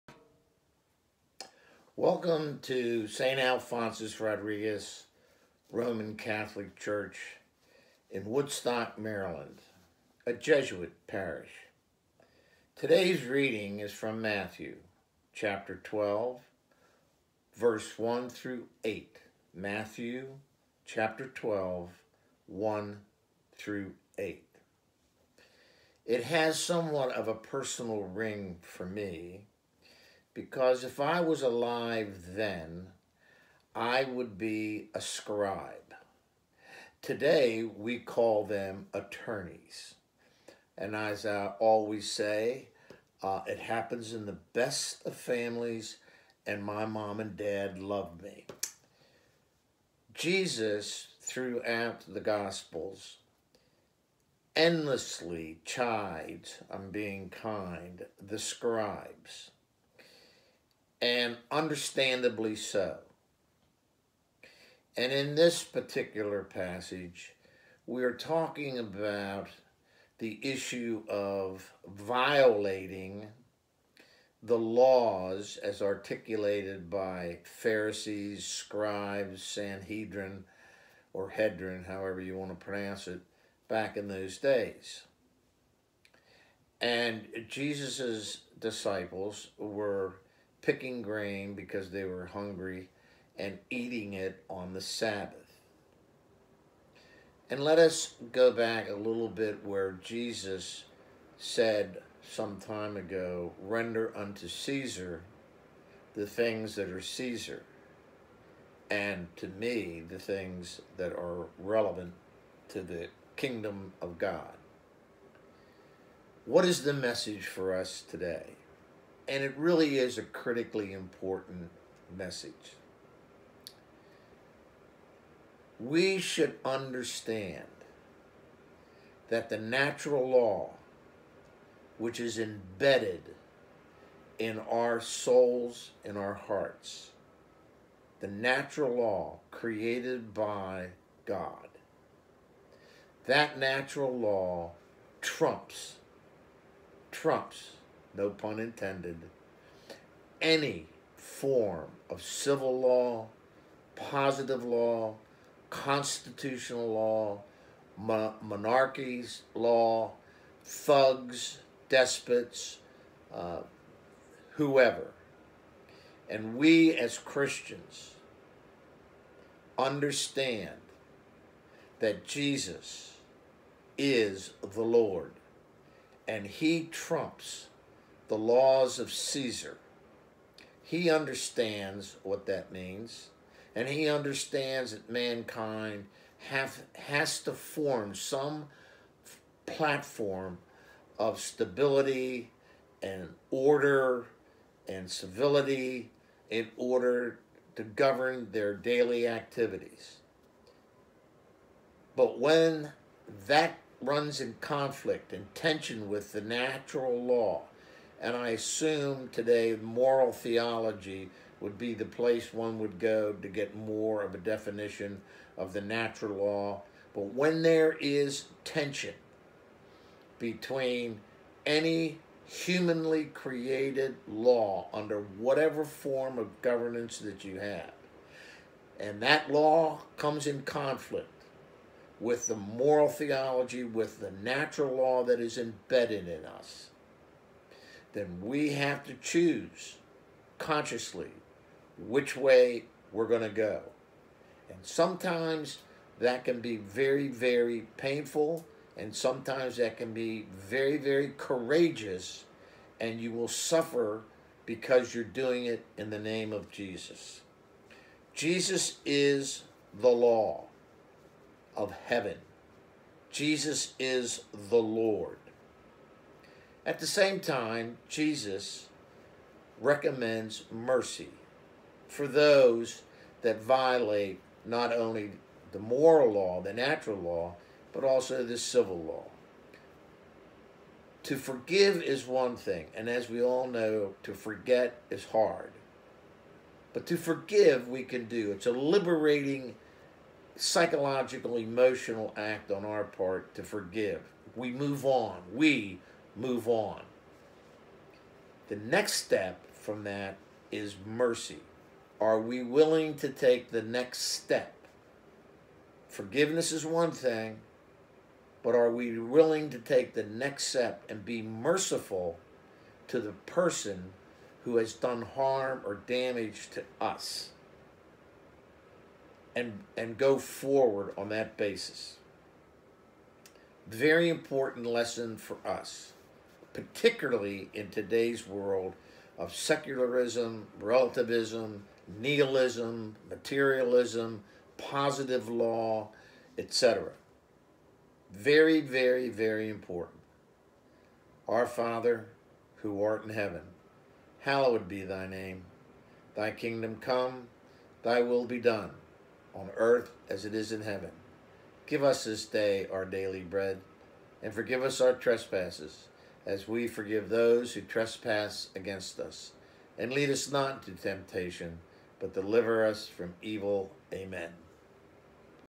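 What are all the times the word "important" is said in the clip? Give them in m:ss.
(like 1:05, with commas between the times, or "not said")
2:00, 5:24, 5:39.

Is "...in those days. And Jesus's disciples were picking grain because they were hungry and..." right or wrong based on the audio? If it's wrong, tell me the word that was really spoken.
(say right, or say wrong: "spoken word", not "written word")
right.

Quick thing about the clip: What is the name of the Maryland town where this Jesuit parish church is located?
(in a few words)
Woodstock.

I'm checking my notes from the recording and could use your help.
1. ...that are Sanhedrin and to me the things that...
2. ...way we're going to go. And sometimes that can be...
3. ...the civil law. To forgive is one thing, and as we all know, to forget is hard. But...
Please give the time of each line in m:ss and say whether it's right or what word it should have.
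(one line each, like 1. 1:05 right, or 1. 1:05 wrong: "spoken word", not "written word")
1. 1:46 wrong: "Caesar", not "Sanhedrin"
2. 4:02 right
3. 4:38 right.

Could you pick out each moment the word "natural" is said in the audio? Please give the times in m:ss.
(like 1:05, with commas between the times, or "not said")
2:09, 2:18, 2:23, 3:26, 3:35, 3:54, 4:36.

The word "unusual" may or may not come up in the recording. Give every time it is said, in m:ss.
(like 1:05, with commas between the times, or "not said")
not said.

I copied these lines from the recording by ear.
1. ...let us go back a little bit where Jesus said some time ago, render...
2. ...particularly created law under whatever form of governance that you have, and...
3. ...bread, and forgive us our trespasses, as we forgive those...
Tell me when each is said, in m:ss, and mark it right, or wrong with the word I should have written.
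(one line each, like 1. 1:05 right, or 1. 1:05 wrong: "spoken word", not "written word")
1. 1:37 right
2. 3:42 wrong: "humanly", not "particularly"
3. 5:53 right.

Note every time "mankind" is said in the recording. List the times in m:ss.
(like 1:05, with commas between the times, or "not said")
3:05.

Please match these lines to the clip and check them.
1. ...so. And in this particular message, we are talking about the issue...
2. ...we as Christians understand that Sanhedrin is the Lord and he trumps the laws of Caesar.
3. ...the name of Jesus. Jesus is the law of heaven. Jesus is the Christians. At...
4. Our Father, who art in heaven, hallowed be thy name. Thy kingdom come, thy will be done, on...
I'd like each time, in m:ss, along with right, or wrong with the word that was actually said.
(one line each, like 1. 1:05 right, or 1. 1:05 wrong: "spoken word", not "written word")
1. 1:02 wrong: "passage", not "message"
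2. 2:46 wrong: "Jesus", not "Sanhedrin"
3. 4:16 wrong: "Lord", not "Christians"
4. 5:41 right.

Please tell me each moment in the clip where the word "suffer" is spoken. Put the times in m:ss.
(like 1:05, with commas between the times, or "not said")
4:13.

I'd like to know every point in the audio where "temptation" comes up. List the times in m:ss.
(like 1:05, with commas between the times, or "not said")
6:01.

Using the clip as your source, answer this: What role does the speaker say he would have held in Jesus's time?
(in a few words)
A scribe.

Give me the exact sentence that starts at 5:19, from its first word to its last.
And, and go forward on that basis.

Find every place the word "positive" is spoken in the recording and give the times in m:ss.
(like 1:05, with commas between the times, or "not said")
2:33, 5:34.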